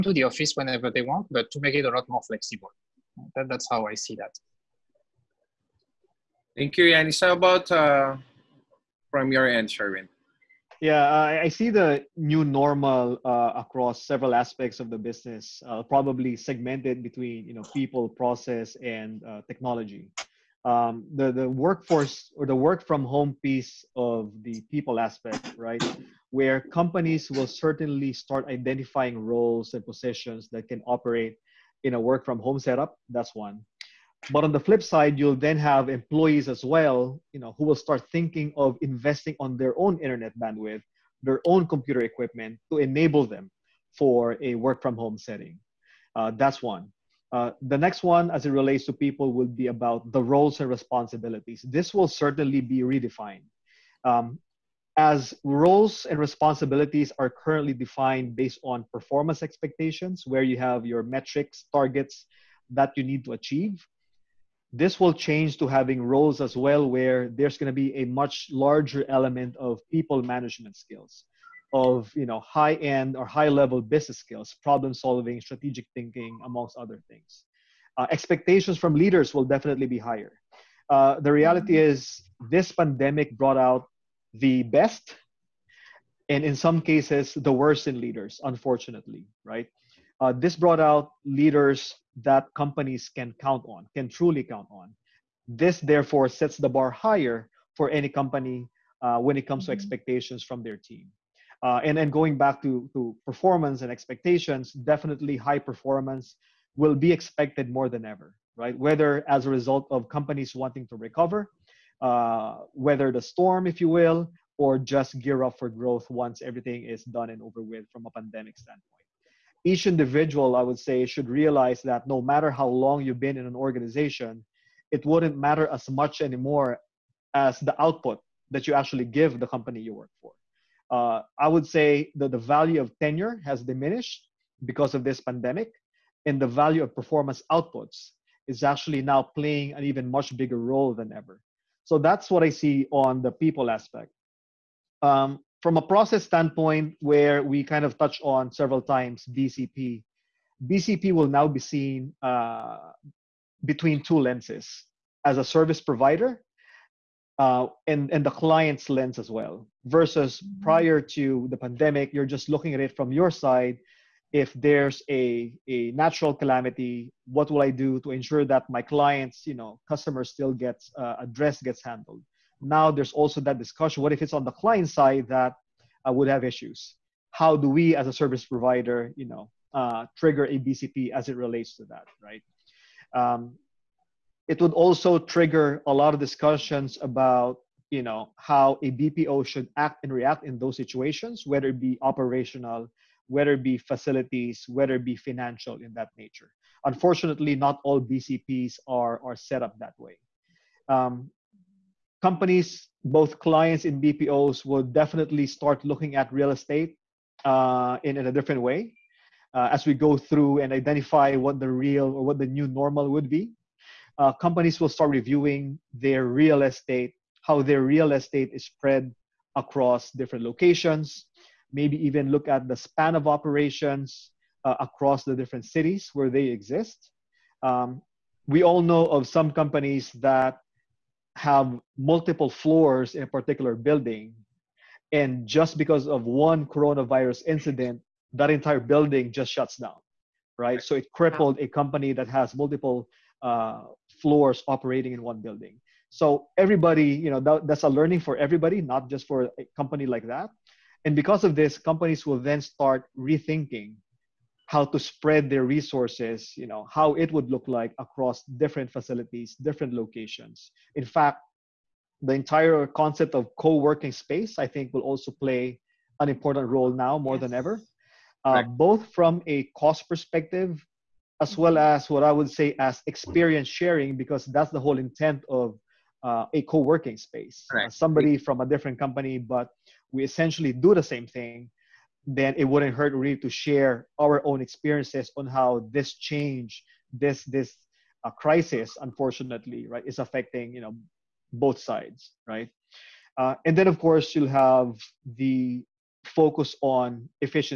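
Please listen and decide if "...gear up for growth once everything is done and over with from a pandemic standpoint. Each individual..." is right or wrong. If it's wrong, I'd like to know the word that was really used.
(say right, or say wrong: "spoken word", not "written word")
right.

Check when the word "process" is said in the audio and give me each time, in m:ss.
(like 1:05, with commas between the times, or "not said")
0:18, 2:25.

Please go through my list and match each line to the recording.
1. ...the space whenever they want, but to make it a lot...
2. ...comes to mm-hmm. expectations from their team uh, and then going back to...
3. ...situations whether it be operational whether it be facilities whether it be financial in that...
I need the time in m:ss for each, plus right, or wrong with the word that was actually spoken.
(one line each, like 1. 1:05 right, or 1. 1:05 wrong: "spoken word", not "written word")
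1. 0:00 wrong: "office", not "space"
2. 1:39 right
3. 3:10 right.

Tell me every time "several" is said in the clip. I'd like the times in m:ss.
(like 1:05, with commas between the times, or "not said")
0:14, 2:28.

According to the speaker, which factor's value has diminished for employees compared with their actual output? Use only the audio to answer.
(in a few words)
Tenure.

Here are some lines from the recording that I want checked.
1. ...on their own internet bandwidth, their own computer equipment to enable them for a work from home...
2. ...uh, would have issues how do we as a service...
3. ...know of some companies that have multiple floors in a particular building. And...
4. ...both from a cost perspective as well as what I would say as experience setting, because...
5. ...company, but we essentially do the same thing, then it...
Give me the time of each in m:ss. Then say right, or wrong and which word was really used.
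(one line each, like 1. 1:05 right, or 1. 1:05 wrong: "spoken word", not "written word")
1. 0:39 right
2. 2:56 right
3. 3:48 right
4. 4:28 wrong: "sharing", not "setting"
5. 4:38 right.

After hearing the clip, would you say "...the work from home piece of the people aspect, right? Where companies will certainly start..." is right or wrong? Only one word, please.
right.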